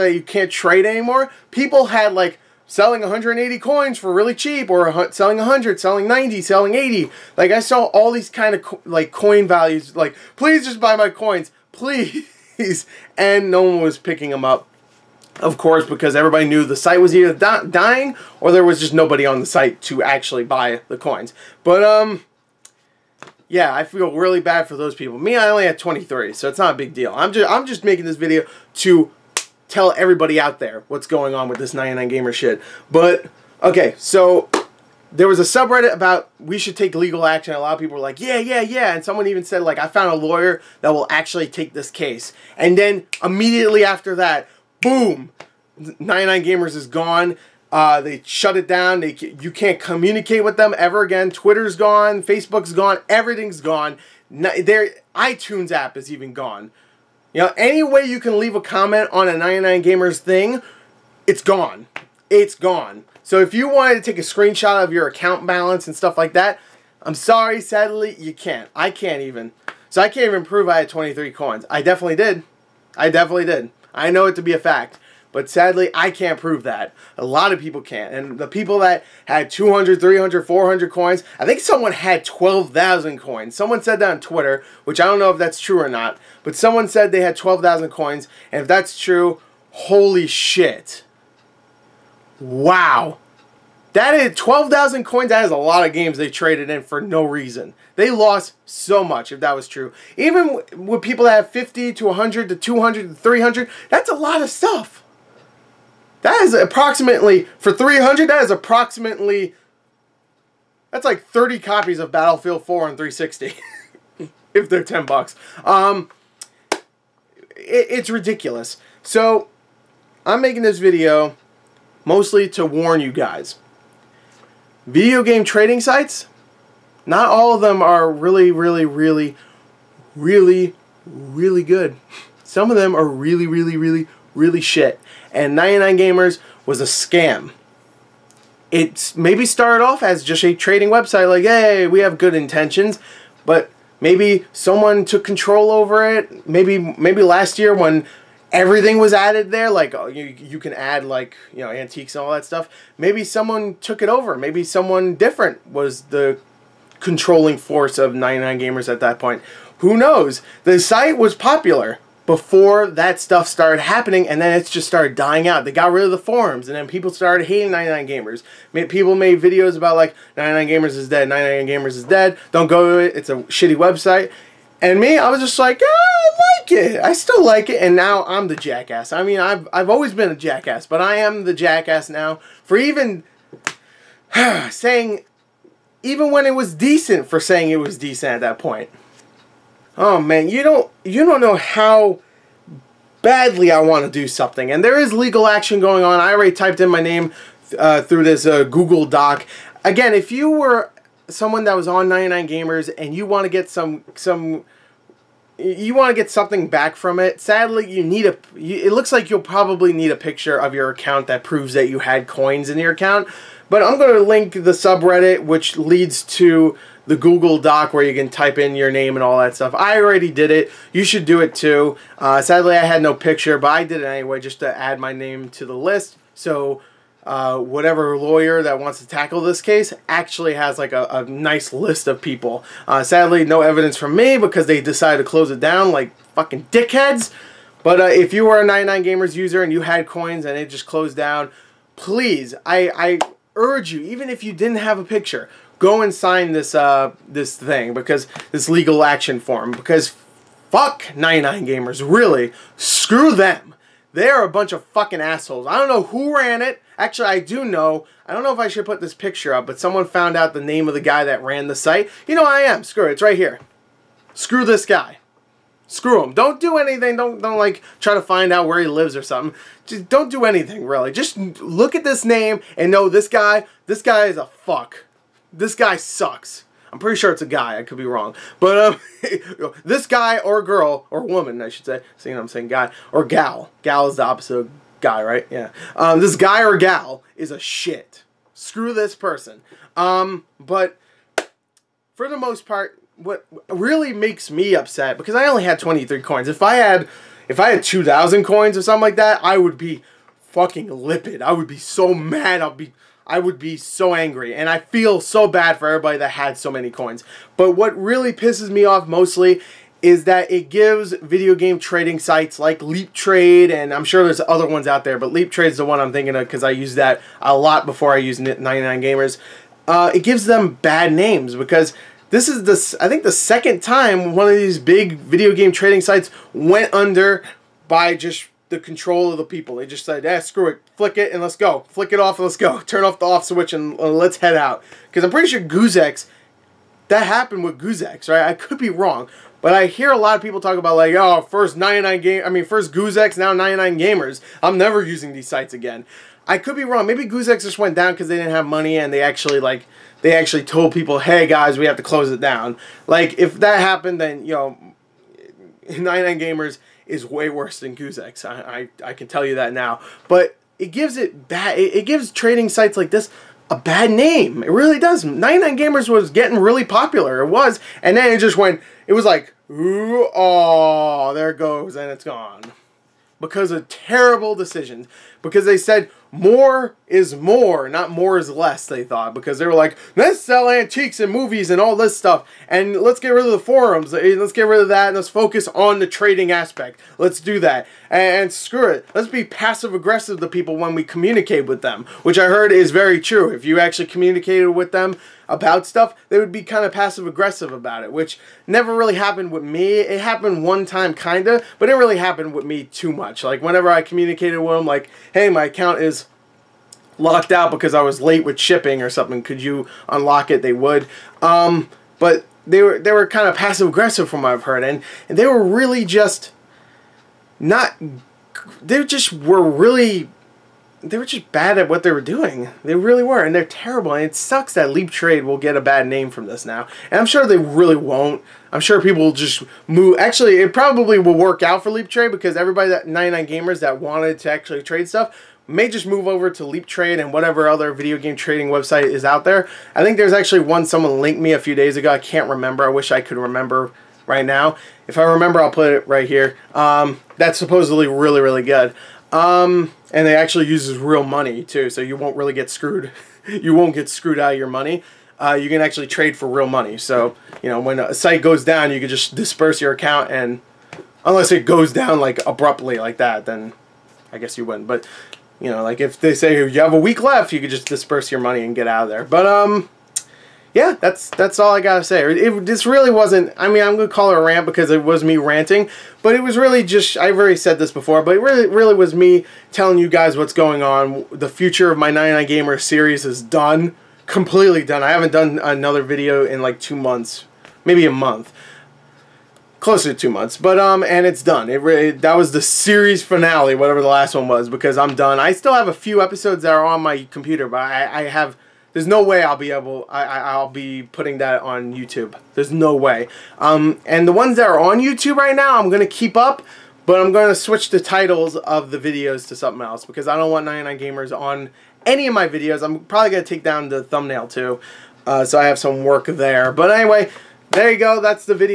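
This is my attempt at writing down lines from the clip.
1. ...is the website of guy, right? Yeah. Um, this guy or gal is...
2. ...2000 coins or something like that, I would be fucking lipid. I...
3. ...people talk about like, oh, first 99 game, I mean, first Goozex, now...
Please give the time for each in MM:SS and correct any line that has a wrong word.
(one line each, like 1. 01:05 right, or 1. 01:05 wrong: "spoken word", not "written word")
1. 04:44 wrong: "opposite", not "website"
2. 04:57 right
3. 05:40 right.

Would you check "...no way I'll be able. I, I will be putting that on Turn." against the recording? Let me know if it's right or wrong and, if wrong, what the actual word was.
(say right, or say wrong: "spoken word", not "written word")
wrong: "YouTube", not "Turn".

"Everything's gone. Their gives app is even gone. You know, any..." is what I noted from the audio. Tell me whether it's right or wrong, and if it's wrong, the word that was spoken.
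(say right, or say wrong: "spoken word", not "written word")
wrong: "iTunes", not "gives".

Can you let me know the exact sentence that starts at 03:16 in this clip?
I already typed in my name uh, through this uh, Google Doc.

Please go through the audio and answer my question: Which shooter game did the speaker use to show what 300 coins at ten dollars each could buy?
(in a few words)
Battlefield 4.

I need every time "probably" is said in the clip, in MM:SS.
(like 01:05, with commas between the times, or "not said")
03:29, 07:10, 08:33.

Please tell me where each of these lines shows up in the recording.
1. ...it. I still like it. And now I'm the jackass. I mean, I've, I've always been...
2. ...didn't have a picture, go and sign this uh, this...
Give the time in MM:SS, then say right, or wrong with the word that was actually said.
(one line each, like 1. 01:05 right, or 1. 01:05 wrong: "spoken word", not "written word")
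1. 02:56 right
2. 04:04 right.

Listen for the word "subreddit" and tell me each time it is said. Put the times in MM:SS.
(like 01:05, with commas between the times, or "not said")
00:35, 03:34.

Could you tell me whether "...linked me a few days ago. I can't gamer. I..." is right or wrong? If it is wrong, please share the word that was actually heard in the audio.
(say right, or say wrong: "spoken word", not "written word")
wrong: "remember", not "gamer".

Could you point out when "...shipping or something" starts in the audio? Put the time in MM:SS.
06:48.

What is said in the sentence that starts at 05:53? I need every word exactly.
Like if that happened, then you know, 99 gamers is way worse than Goozex.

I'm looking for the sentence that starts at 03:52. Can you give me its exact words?
Uh, sadly, no evidence from me because they decided to close it down like fucking dickheads.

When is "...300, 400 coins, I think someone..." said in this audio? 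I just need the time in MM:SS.
01:20.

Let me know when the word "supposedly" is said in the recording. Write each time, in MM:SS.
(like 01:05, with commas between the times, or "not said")
07:27.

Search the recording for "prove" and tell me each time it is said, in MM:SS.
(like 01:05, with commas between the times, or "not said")
01:10, 01:16, 03:31.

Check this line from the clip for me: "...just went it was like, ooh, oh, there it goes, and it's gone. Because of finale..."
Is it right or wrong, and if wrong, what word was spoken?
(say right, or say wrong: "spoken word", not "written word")
wrong: "terrible", not "finale".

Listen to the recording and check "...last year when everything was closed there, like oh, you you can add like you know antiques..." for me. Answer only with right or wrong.
wrong.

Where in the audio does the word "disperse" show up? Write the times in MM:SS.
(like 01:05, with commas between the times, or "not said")
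07:39, 07:47.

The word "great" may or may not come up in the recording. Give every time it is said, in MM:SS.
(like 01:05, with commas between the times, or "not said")
not said.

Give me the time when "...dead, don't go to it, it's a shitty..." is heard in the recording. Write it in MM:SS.
02:52.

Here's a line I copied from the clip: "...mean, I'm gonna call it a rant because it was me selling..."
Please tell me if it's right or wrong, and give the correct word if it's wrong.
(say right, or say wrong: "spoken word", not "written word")
wrong: "ranting", not "selling".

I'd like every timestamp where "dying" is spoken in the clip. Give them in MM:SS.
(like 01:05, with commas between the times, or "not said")
00:17, 02:45.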